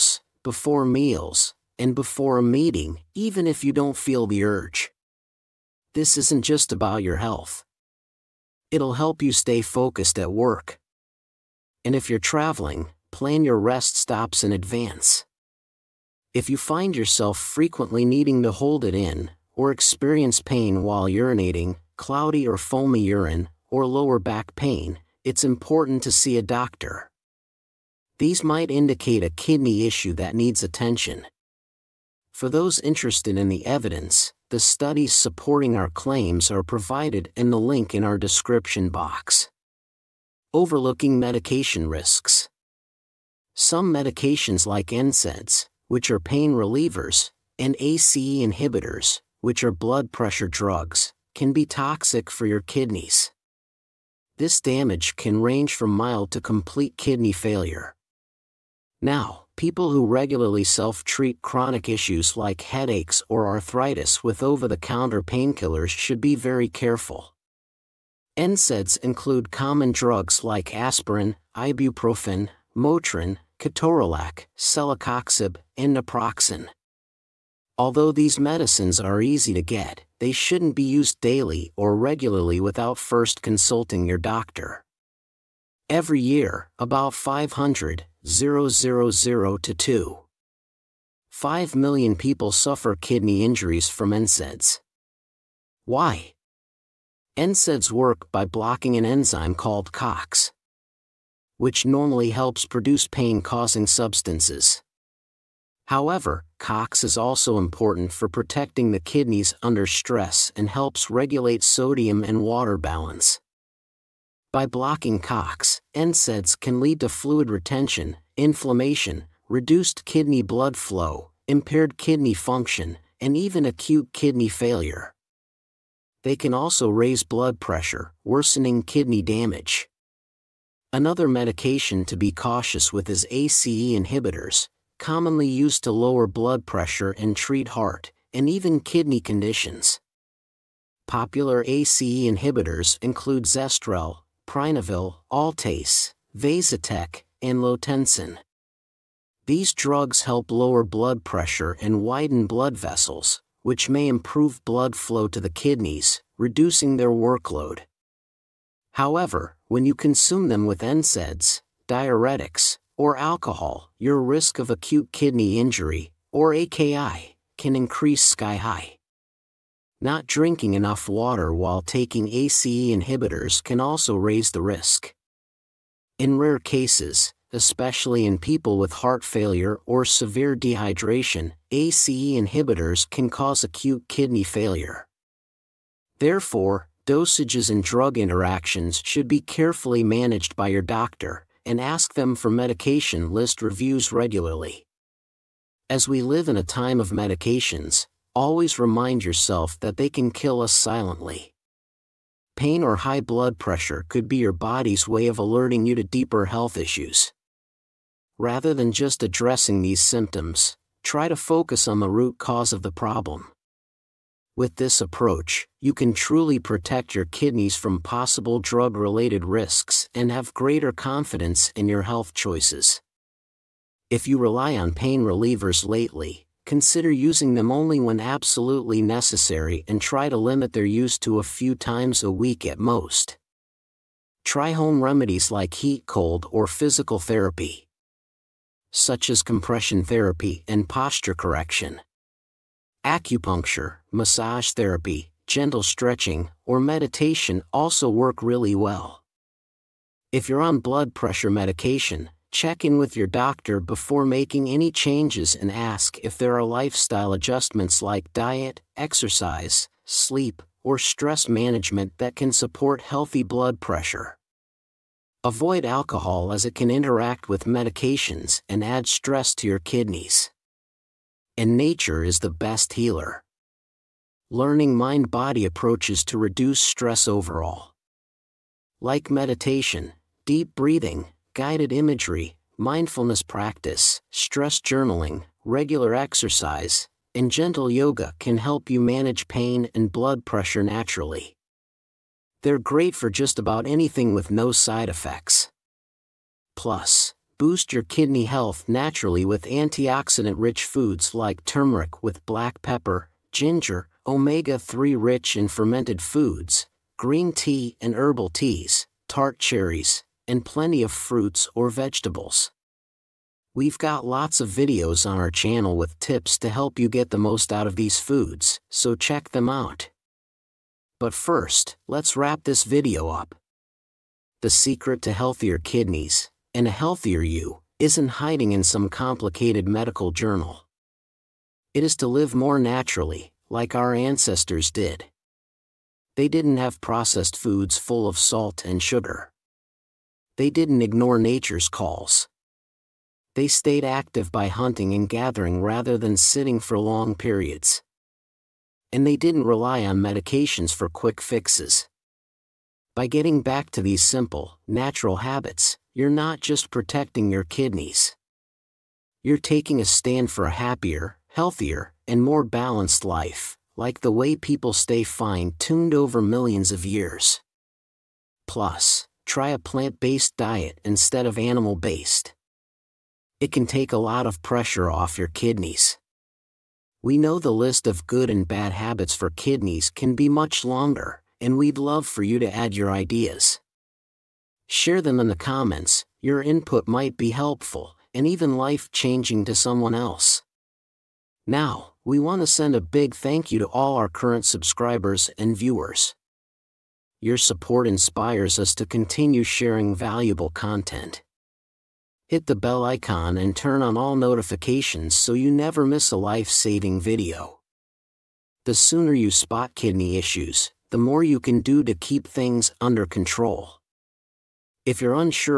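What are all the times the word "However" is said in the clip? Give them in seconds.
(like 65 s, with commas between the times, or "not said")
105 s, 158 s.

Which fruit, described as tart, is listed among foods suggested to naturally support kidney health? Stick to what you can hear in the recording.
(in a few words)
Tart cherries.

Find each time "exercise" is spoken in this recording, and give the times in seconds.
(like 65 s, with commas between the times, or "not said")
258 s, 286 s.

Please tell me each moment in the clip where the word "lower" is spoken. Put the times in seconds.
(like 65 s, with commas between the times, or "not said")
23 s, 135 s, 150 s.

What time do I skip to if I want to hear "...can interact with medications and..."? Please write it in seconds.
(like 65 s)
266 s.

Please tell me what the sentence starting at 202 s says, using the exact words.
Pain or high blood pressure could be your body's way of alerting you to deeper health issues.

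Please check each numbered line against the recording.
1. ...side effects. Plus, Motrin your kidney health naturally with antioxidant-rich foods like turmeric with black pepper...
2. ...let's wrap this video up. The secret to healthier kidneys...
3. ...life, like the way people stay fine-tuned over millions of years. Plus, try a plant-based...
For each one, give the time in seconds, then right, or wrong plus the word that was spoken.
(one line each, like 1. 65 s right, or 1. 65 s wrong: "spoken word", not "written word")
1. 294 s wrong: "Boost", not "Motrin"
2. 322 s right
3. 363 s right.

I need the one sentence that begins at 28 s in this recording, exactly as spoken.
These might indicate a kidney issue that needs attention.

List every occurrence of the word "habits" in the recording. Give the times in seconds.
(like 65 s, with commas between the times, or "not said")
355 s, 378 s.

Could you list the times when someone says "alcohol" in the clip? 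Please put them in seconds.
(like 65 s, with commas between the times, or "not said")
163 s, 265 s.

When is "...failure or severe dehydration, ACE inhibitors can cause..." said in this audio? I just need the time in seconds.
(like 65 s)
179 s.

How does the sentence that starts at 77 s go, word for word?
Although these medicines are easy to get, they shouldn't be used daily or regularly without first consulting your doctor.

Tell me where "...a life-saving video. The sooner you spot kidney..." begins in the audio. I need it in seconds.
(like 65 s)
406 s.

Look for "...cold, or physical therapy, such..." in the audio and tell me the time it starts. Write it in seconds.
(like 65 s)
236 s.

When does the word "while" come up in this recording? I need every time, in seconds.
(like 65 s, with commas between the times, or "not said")
20 s, 171 s.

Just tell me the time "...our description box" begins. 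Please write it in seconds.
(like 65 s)
38 s.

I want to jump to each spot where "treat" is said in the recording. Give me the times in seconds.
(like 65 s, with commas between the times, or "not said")
60 s, 137 s.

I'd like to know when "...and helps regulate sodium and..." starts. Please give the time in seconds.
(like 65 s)
110 s.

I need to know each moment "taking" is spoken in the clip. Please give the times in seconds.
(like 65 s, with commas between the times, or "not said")
171 s, 359 s.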